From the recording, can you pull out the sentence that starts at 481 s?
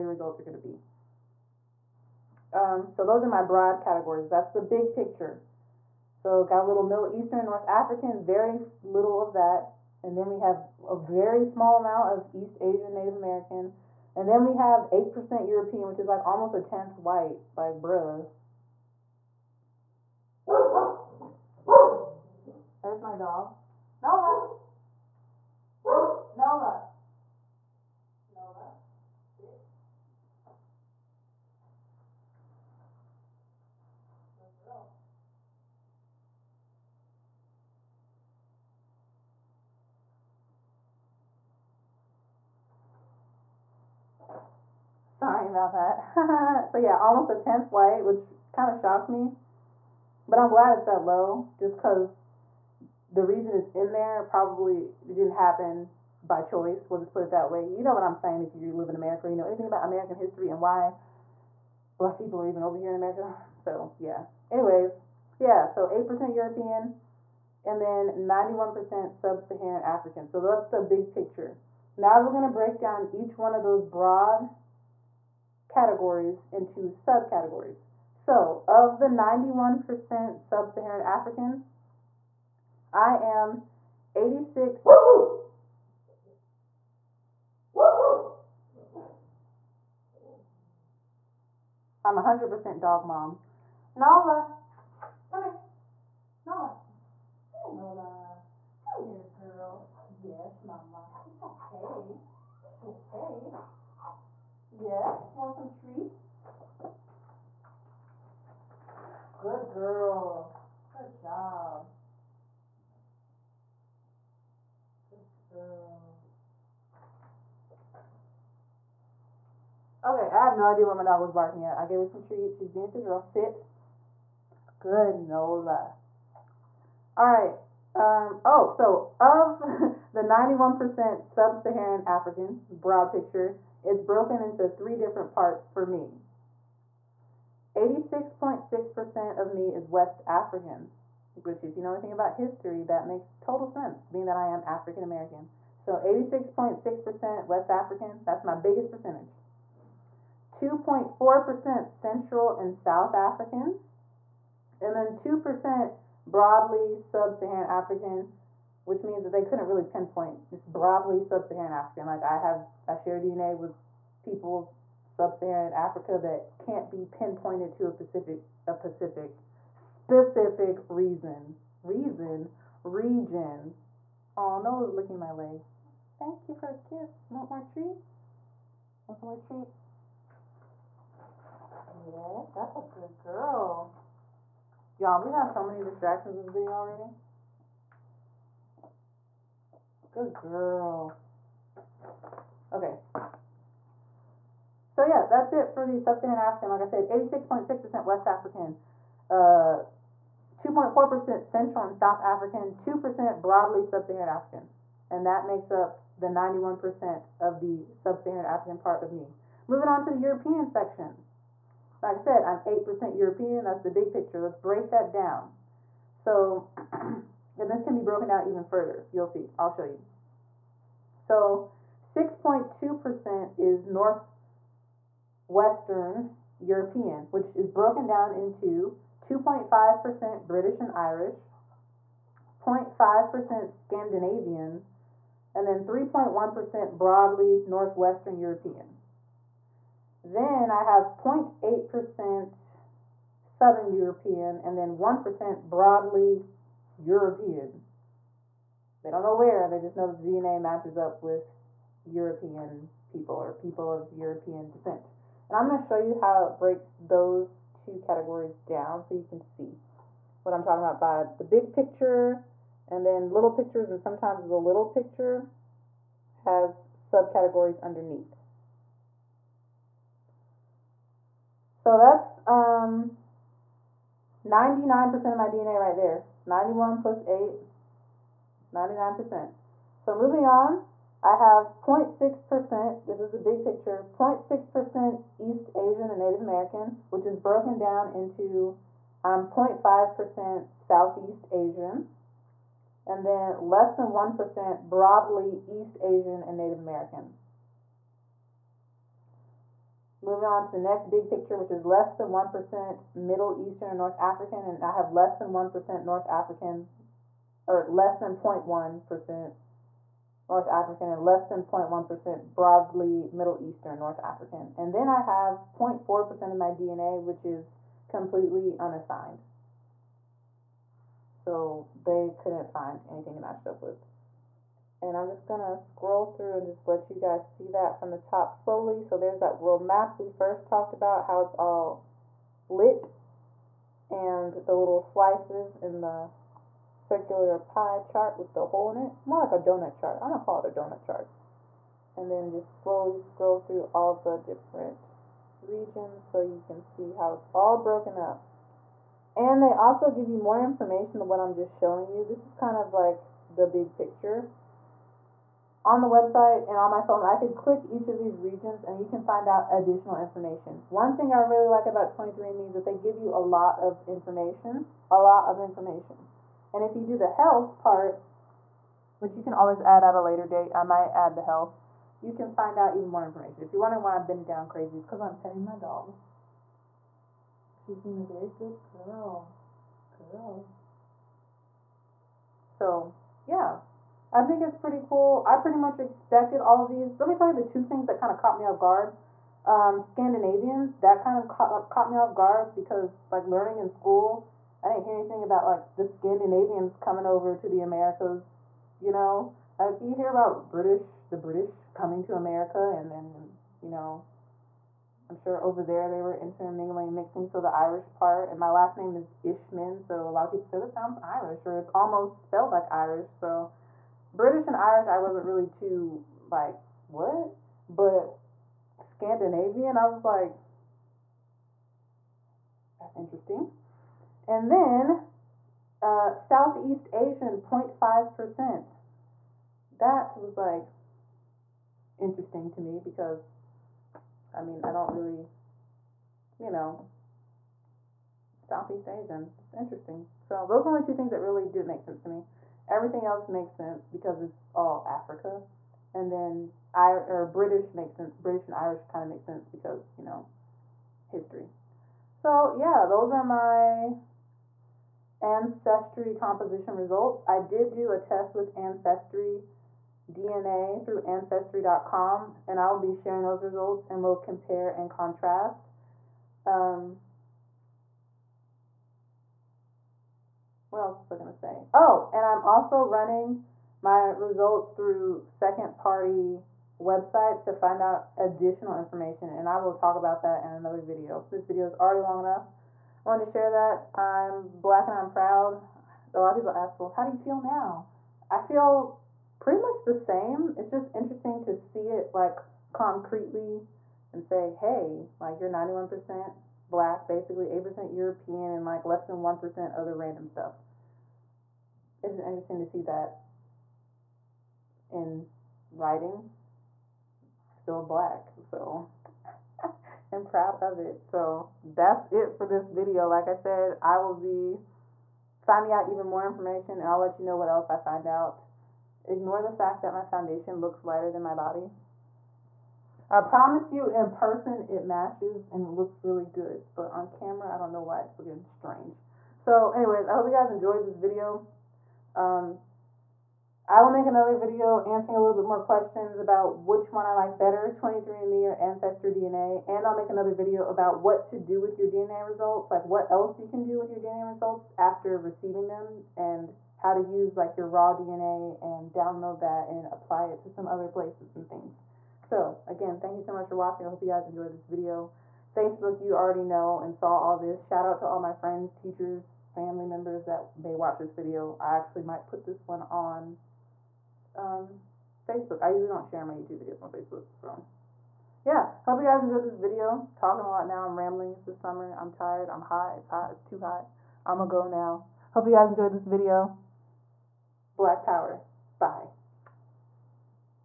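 This video is already long enough wanted to share that.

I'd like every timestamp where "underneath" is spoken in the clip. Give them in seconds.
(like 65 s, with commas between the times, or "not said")
267 s.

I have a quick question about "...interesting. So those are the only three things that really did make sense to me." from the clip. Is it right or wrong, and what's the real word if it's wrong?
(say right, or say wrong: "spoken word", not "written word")
wrong: "two", not "three".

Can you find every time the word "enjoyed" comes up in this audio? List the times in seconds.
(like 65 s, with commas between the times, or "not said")
530 s, 554 s, 569 s, 575 s.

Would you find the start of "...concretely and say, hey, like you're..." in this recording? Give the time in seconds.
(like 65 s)
492 s.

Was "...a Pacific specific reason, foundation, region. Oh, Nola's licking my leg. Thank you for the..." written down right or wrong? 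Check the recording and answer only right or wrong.
wrong.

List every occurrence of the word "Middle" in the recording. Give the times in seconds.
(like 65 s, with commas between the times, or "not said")
6 s, 303 s, 313 s.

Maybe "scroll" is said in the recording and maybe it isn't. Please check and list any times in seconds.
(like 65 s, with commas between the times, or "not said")
325 s, 343 s.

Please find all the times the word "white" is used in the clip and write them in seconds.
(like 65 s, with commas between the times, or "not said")
16 s, 47 s.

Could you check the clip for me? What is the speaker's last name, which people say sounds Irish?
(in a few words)
Ishman.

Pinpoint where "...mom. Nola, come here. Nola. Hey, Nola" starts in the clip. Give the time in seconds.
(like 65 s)
93 s.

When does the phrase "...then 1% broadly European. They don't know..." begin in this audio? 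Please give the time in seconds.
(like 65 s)
244 s.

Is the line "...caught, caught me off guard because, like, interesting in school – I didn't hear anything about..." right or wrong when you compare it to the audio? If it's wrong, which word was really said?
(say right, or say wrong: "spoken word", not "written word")
wrong: "learning", not "interesting".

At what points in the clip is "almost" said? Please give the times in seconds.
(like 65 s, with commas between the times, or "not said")
16 s, 47 s, 411 s.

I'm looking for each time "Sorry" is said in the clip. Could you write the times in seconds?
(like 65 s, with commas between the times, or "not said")
45 s.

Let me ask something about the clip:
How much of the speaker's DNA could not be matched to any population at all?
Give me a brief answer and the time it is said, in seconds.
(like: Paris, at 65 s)
0.4%, at 315 s.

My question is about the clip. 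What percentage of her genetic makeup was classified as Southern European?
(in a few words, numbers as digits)
0.8%.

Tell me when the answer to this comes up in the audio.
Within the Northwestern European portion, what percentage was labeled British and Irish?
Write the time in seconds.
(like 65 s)
229 s.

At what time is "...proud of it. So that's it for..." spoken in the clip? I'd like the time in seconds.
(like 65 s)
510 s.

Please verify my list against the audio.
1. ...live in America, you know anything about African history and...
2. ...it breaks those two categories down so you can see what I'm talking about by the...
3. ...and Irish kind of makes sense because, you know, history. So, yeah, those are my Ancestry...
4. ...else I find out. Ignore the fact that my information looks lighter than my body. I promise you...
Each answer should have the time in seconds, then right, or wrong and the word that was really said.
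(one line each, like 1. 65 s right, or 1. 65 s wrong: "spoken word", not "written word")
1. 58 s wrong: "American", not "African"
2. 256 s right
3. 448 s right
4. 517 s wrong: "foundation", not "information".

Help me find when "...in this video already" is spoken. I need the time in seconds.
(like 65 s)
186 s.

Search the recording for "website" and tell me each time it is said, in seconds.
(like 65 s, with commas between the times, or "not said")
356 s, 476 s.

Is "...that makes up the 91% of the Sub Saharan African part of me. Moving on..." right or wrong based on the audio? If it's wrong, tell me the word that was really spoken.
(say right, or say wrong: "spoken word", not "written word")
right.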